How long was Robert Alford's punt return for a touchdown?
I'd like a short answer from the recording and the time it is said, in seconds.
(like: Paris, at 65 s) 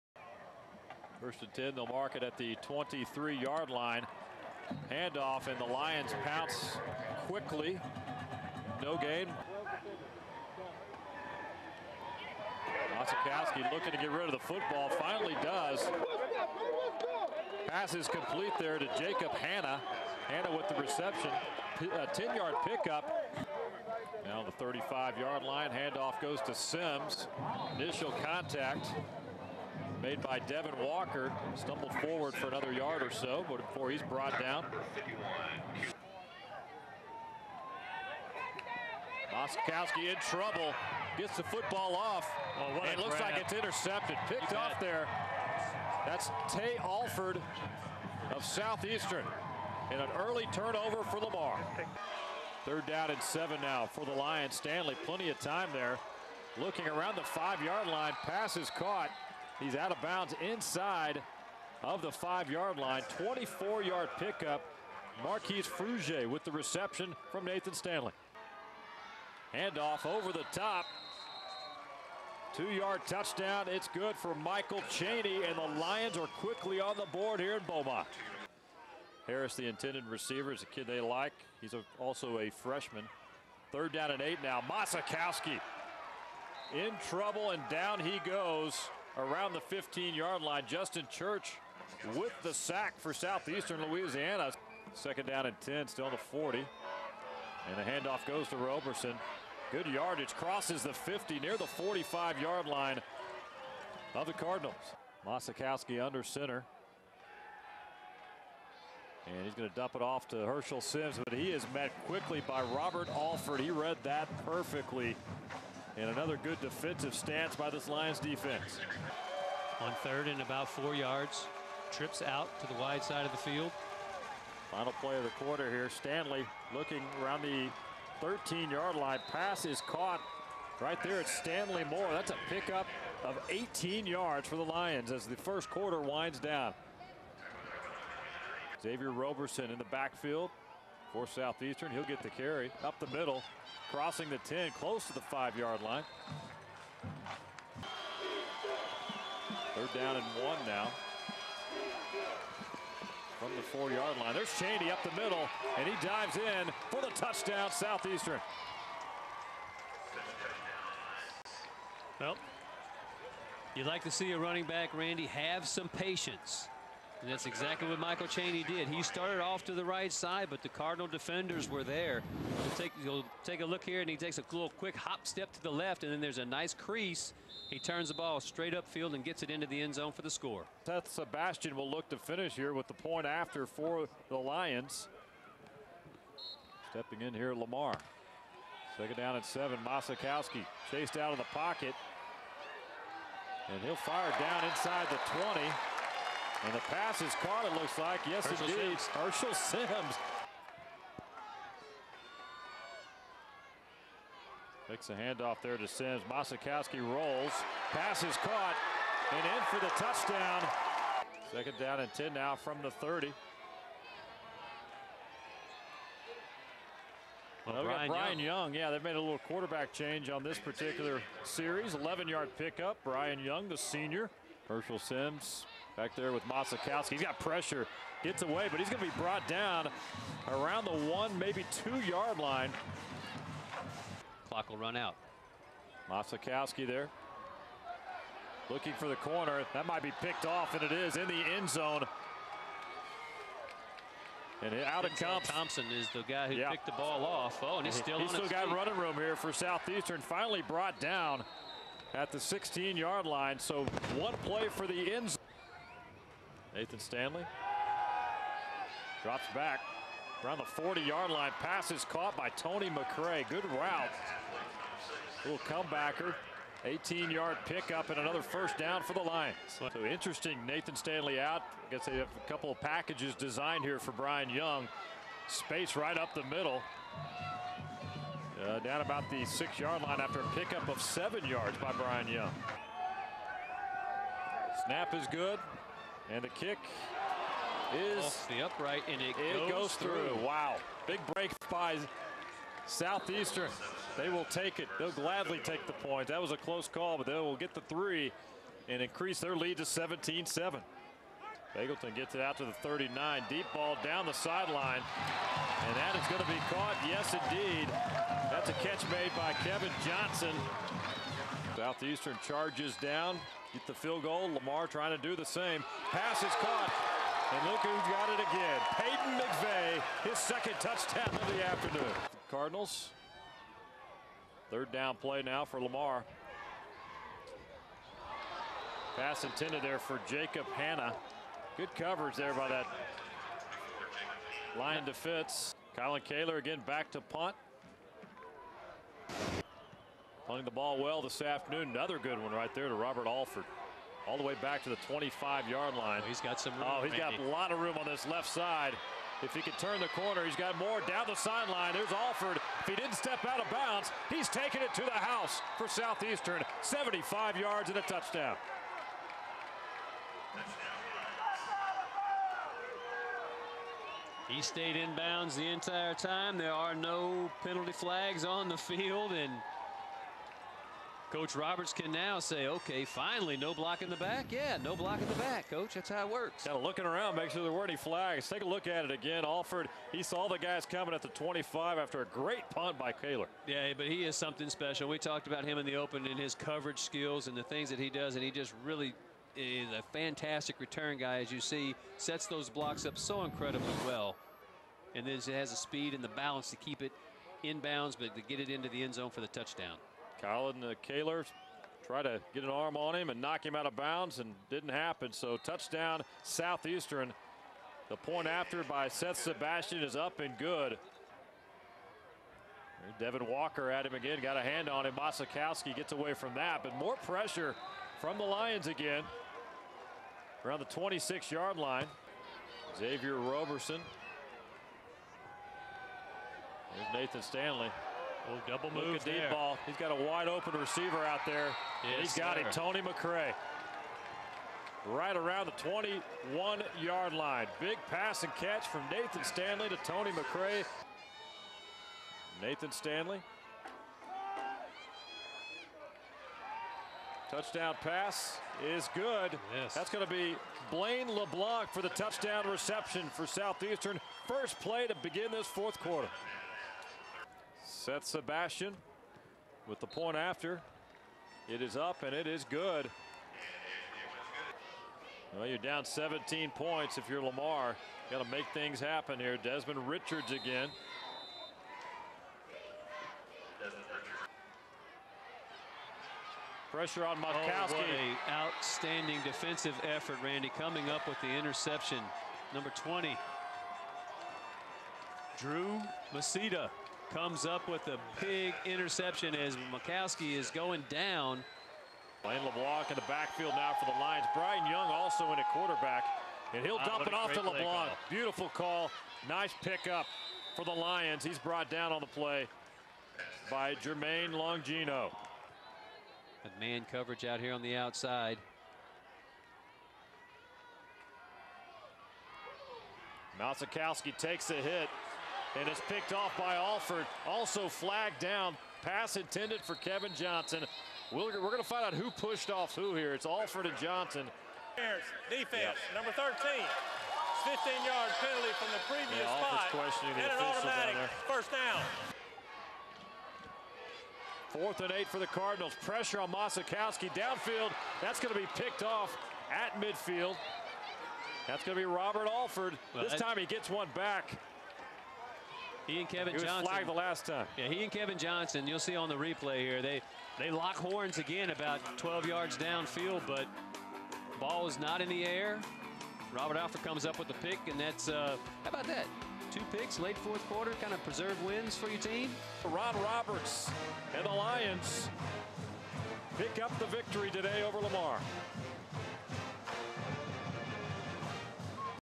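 75 yards, at 356 s.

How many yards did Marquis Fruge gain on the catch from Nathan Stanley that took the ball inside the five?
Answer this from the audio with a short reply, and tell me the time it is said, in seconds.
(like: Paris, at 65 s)
24, at 63 s.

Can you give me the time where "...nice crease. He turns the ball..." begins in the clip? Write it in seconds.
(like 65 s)
176 s.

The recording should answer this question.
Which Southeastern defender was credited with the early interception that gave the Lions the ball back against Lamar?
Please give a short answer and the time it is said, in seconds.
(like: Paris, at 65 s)
Tay Alford, at 46 s.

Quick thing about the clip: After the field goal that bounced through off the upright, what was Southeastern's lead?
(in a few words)
17-7.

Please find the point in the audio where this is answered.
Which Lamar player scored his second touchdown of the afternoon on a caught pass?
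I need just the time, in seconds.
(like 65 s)
318 s.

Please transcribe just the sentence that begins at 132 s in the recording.
That's a pickup of 18 yards for the Lions as the first quarter winds down.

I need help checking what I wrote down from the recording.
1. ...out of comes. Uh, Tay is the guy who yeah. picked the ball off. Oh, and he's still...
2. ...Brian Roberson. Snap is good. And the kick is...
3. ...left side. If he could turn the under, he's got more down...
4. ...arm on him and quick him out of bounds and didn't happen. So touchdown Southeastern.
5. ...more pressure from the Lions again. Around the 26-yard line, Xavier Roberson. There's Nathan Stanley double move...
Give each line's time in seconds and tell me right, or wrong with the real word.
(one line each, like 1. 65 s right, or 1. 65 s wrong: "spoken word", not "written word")
1. 244 s wrong: "Thompson", not "Tay"
2. 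281 s wrong: "Young", not "Roberson"
3. 348 s wrong: "corner", not "under"
4. 402 s wrong: "knock", not "quick"
5. 416 s right.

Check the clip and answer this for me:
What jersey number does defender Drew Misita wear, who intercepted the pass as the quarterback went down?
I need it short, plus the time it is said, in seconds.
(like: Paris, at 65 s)
20, at 482 s.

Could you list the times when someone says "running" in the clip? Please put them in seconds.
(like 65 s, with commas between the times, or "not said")
164 s, 248 s.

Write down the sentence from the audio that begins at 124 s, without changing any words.
Final play of the quarter here.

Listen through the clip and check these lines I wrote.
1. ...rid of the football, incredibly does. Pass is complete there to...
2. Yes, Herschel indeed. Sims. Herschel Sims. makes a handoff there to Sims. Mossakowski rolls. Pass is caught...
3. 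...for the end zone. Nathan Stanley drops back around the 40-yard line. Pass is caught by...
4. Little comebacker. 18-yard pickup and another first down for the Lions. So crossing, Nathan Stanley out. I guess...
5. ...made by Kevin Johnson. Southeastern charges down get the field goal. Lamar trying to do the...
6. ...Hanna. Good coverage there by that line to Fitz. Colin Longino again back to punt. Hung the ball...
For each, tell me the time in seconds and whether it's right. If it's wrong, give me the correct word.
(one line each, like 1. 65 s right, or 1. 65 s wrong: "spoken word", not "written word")
1. 14 s wrong: "finally", not "incredibly"
2. 198 s right
3. 254 s right
4. 265 s wrong: "interesting", not "crossing"
5. 309 s right
6. 330 s wrong: "Kaler", not "Longino".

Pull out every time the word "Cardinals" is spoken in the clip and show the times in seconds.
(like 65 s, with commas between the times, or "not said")
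104 s, 170 s, 322 s, 535 s.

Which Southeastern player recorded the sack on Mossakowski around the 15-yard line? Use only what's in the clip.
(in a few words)
Justin Church.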